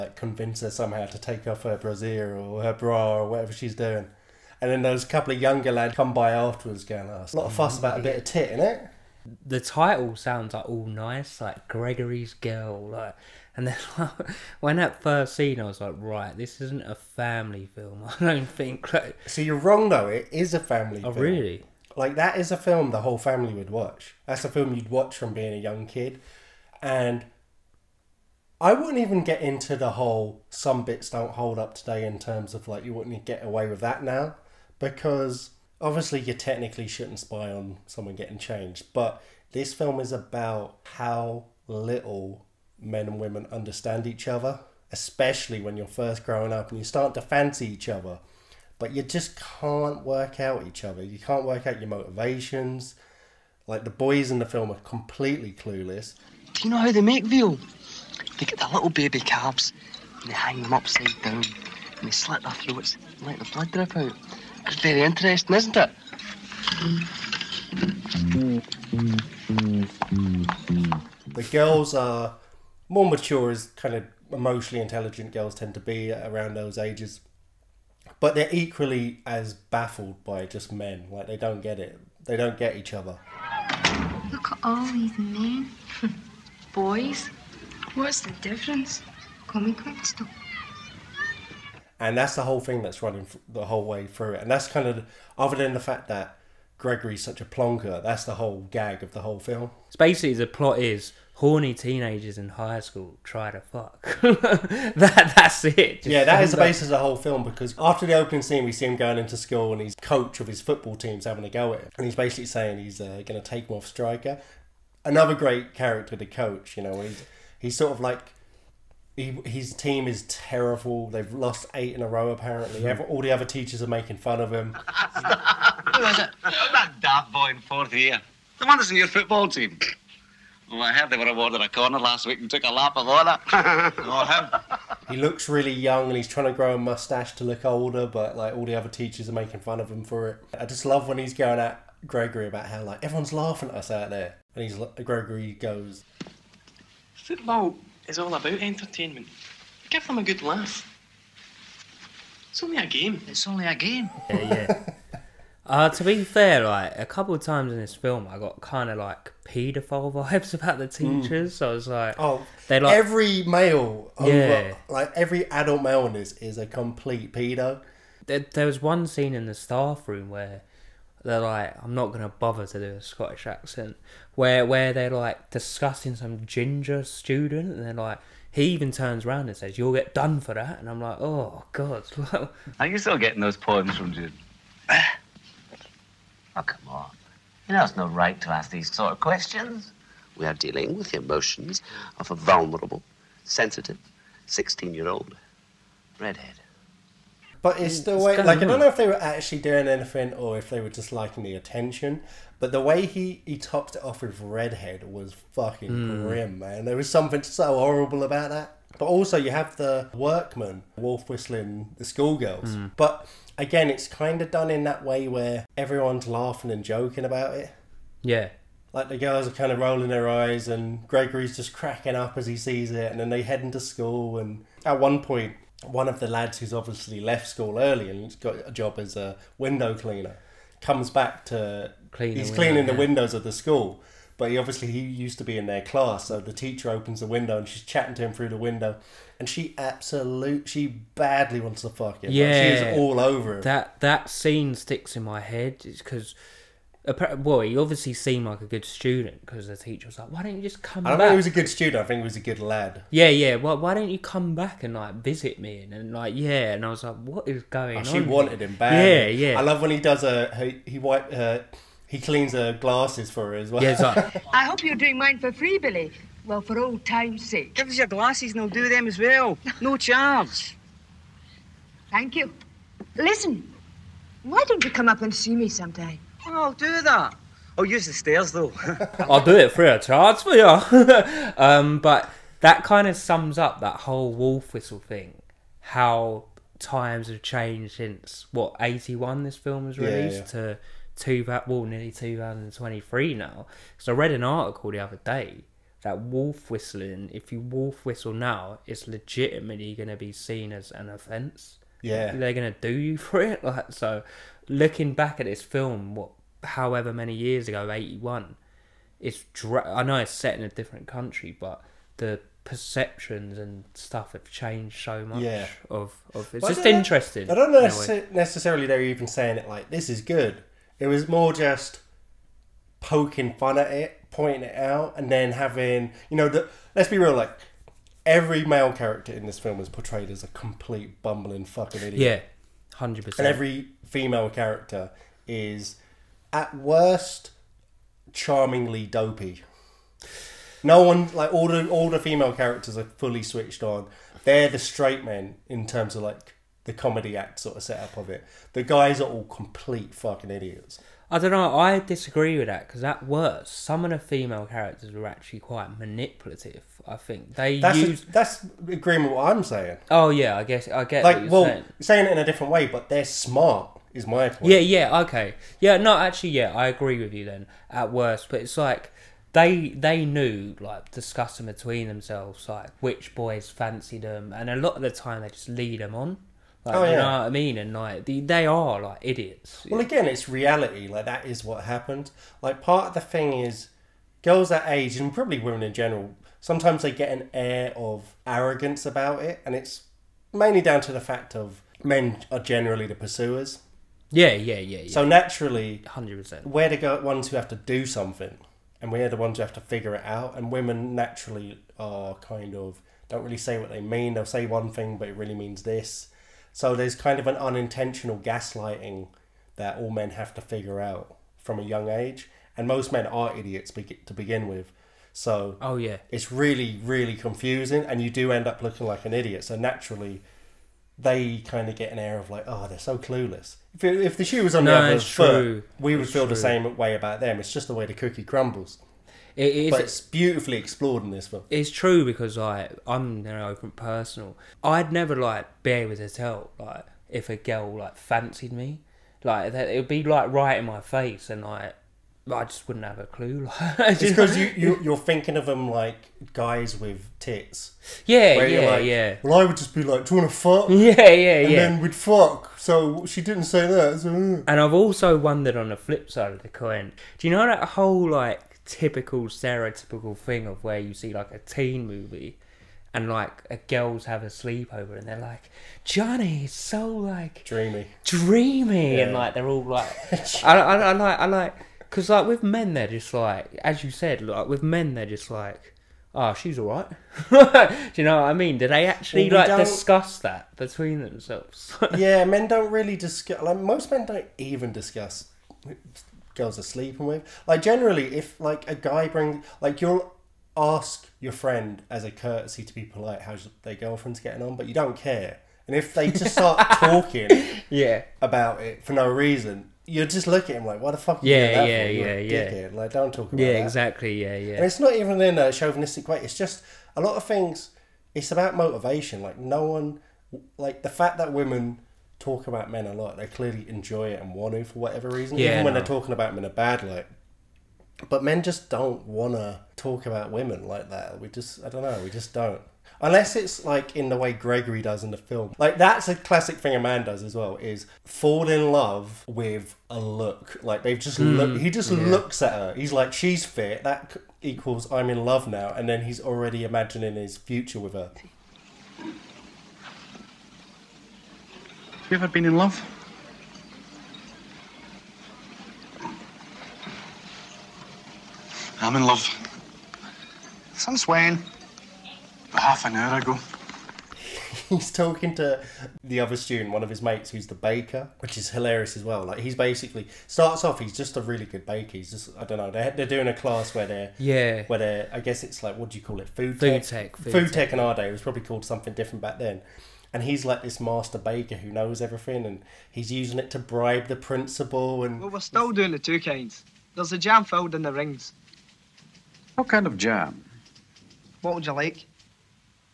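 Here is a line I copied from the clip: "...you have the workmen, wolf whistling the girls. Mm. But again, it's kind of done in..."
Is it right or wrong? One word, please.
wrong.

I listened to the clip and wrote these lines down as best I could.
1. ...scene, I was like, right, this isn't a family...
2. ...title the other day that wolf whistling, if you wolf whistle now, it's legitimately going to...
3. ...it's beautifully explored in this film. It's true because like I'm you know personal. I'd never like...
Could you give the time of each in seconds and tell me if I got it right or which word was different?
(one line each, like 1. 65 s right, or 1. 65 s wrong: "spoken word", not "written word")
1. 15 s right
2. 294 s wrong: "article", not "title"
3. 430 s right.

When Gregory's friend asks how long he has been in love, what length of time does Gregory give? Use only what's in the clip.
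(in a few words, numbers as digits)
Half an hour.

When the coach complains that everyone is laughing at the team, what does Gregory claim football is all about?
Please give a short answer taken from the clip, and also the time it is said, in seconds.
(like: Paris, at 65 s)
Entertainment, at 148 s.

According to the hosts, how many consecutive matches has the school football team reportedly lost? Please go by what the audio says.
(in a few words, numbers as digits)
8.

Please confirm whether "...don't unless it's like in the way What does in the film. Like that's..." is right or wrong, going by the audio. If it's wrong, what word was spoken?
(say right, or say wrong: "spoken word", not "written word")
wrong: "Gregory", not "What".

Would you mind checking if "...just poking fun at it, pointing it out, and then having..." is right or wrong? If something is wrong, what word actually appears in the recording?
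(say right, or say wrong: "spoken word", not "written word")
right.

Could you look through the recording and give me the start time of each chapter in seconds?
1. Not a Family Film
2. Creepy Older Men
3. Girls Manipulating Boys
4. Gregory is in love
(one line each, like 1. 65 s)
1. 10 s
2. 150 s
3. 345 s
4. 546 s.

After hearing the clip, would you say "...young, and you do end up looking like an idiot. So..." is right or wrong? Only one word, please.
wrong.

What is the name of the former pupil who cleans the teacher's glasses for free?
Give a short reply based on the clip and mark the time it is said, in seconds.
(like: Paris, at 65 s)
Billy, at 265 s.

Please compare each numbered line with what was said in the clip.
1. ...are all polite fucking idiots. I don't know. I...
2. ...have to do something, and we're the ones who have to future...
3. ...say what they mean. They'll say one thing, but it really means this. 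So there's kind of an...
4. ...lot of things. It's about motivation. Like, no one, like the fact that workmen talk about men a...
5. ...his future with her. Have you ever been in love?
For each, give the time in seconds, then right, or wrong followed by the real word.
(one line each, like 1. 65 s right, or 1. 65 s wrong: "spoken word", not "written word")
1. 349 s wrong: "complete", not "polite"
2. 397 s wrong: "figure", not "future"
3. 403 s right
4. 507 s wrong: "women", not "workmen"
5. 537 s right.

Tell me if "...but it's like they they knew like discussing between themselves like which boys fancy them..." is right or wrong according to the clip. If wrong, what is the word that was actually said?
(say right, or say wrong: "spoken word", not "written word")
right.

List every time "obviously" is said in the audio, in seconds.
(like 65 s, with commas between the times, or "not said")
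35 s, 226 s, 234 s, 247 s.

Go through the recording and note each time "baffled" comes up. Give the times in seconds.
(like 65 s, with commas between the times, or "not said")
79 s.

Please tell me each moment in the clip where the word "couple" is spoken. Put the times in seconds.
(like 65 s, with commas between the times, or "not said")
5 s, 157 s.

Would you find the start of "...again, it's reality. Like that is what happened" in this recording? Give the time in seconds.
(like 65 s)
380 s.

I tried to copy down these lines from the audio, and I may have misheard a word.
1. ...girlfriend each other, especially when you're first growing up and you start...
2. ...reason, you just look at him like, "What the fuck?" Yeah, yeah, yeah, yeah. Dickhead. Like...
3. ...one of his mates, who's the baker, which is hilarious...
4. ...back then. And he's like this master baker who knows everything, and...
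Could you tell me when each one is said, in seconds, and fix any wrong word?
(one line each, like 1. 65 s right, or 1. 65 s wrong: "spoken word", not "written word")
1. 43 s wrong: "understand", not "girlfriend"
2. 499 s right
3. 556 s right
4. 569 s right.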